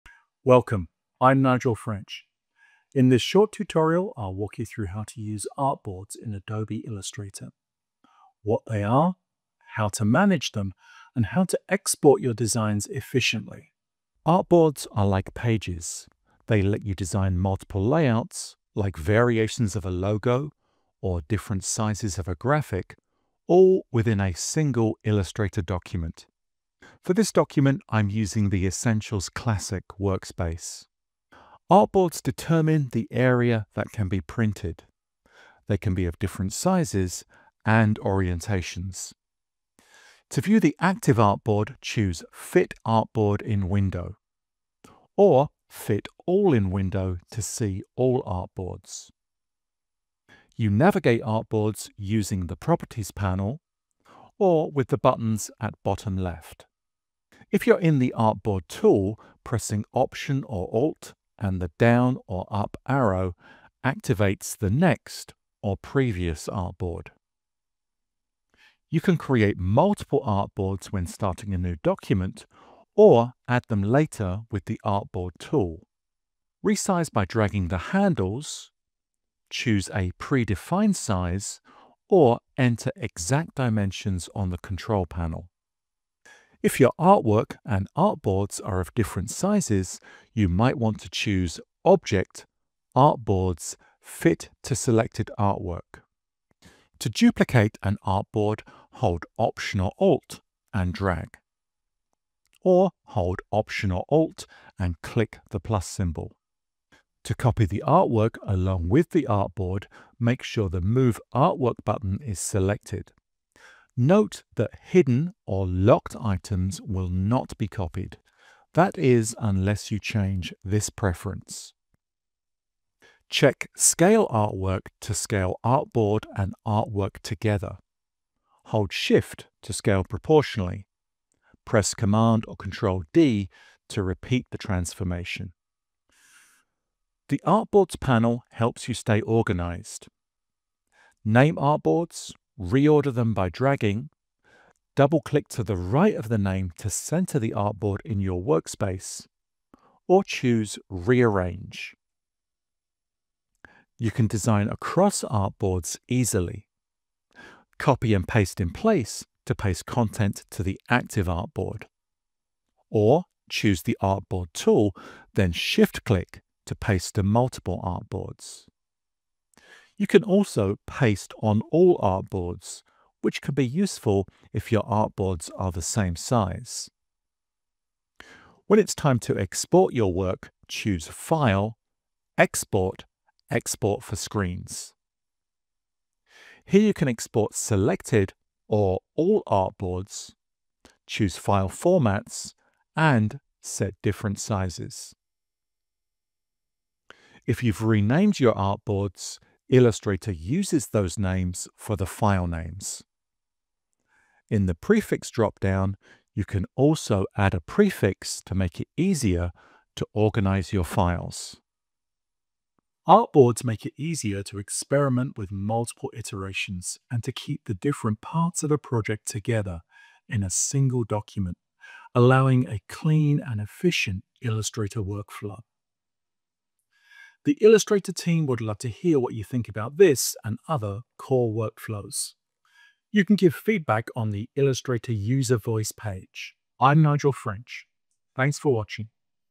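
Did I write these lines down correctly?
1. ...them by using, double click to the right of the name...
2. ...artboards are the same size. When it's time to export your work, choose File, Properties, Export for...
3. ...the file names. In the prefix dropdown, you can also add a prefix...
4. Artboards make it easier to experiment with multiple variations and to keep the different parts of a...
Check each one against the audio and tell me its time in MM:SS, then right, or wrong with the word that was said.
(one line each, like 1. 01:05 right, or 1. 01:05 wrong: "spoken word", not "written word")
1. 02:23 wrong: "dragging", not "using"
2. 02:54 wrong: "Export", not "Properties"
3. 03:21 right
4. 03:33 wrong: "iterations", not "variations".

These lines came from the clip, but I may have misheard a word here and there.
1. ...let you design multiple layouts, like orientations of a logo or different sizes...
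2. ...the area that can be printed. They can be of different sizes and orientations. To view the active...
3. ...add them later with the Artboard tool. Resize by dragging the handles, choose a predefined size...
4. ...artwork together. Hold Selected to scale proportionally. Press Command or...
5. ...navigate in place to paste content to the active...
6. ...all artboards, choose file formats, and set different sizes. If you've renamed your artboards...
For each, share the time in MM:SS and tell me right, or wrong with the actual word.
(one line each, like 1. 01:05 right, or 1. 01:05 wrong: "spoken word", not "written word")
1. 00:16 wrong: "variations", not "orientations"
2. 00:32 right
3. 01:13 right
4. 02:06 wrong: "Shift", not "Selected"
5. 02:38 wrong: "paste", not "navigate"
6. 03:09 right.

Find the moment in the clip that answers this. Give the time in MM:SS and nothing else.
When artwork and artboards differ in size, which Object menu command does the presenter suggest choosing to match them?
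01:33.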